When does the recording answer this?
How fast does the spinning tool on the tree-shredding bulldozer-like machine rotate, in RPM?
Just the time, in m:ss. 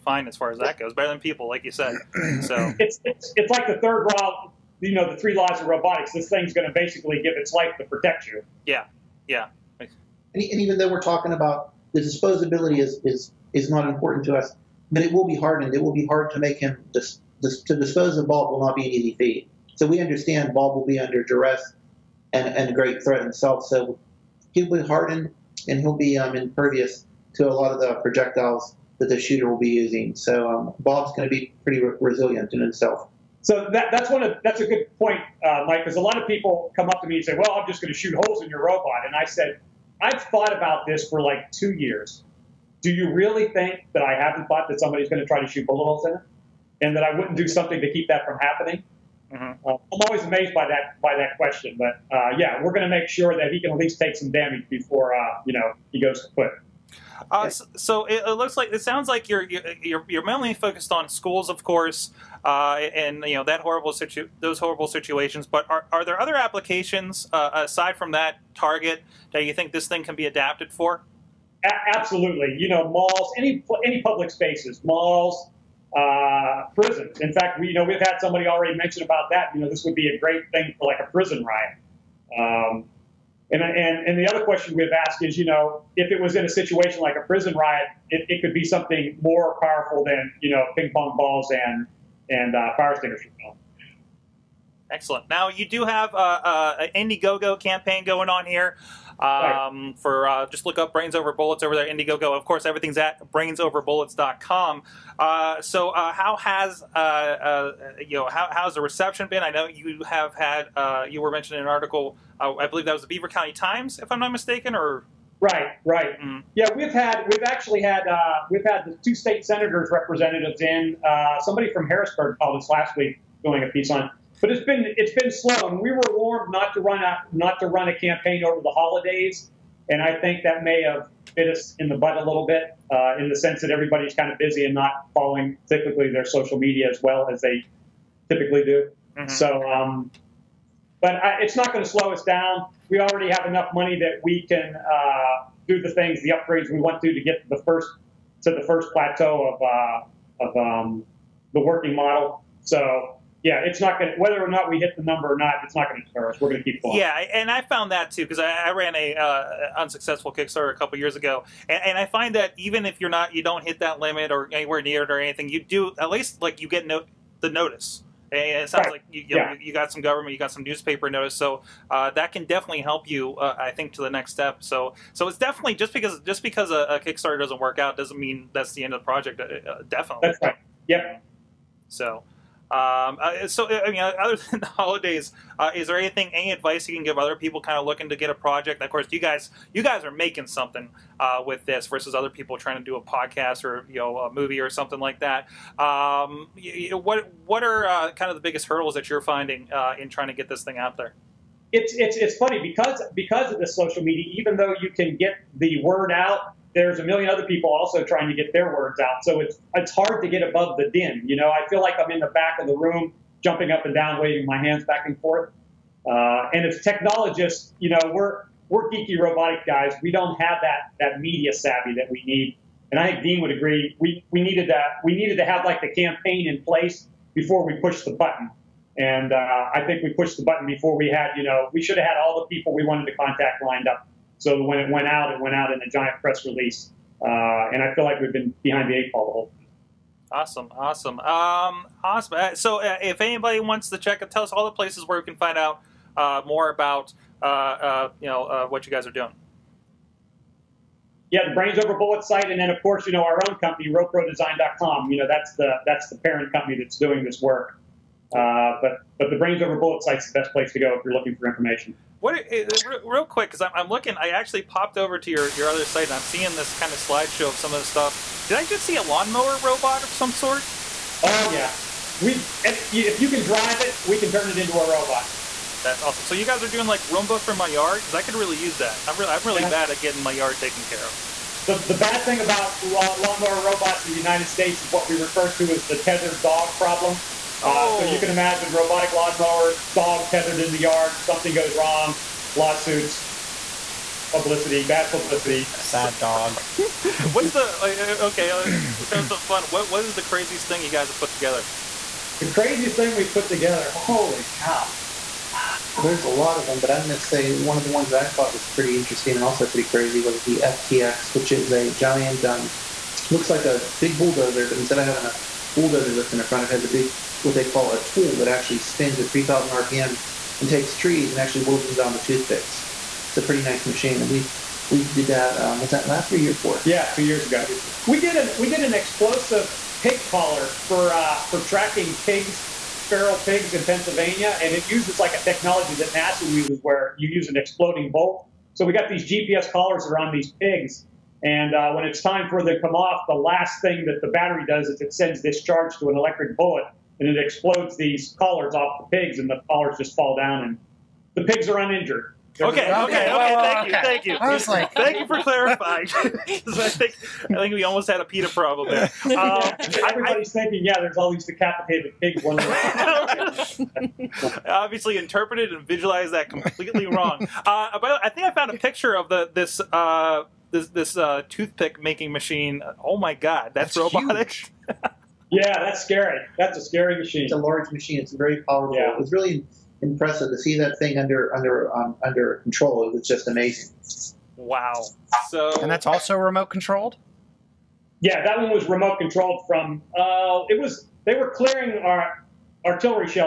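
5:19.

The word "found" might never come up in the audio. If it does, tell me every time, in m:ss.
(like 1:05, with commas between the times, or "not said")
2:37, 6:08.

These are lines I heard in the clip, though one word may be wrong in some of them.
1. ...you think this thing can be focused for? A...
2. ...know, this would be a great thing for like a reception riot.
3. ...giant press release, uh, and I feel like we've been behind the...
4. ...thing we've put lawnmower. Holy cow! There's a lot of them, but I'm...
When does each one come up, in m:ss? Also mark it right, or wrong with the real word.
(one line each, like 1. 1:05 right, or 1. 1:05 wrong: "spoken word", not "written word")
1. 1:09 wrong: "adapted", not "focused"
2. 1:19 wrong: "prison", not "reception"
3. 3:55 right
4. 5:02 wrong: "together", not "lawnmower".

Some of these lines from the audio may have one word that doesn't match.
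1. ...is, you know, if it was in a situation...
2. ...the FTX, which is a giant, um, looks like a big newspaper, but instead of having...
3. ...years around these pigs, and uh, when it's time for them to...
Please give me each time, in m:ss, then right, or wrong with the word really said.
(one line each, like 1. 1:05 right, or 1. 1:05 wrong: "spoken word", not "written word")
1. 1:25 right
2. 5:10 wrong: "bulldozer", not "newspaper"
3. 5:39 wrong: "collars", not "years".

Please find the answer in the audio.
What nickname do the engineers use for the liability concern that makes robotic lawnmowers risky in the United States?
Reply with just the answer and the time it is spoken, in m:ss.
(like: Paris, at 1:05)
Tethered dog problem, at 4:46.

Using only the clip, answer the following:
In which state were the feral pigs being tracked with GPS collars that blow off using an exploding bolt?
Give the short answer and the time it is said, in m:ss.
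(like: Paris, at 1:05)
Pennsylvania, at 5:33.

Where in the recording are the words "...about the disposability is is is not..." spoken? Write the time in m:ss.
0:11.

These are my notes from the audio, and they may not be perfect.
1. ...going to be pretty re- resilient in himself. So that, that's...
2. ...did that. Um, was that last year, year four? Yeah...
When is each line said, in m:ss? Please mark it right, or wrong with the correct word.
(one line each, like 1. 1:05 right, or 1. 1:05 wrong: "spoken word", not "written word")
1. 0:31 right
2. 5:25 right.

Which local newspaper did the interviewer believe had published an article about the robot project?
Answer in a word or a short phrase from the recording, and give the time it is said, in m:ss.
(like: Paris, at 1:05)
Beaver County Times, at 1:53.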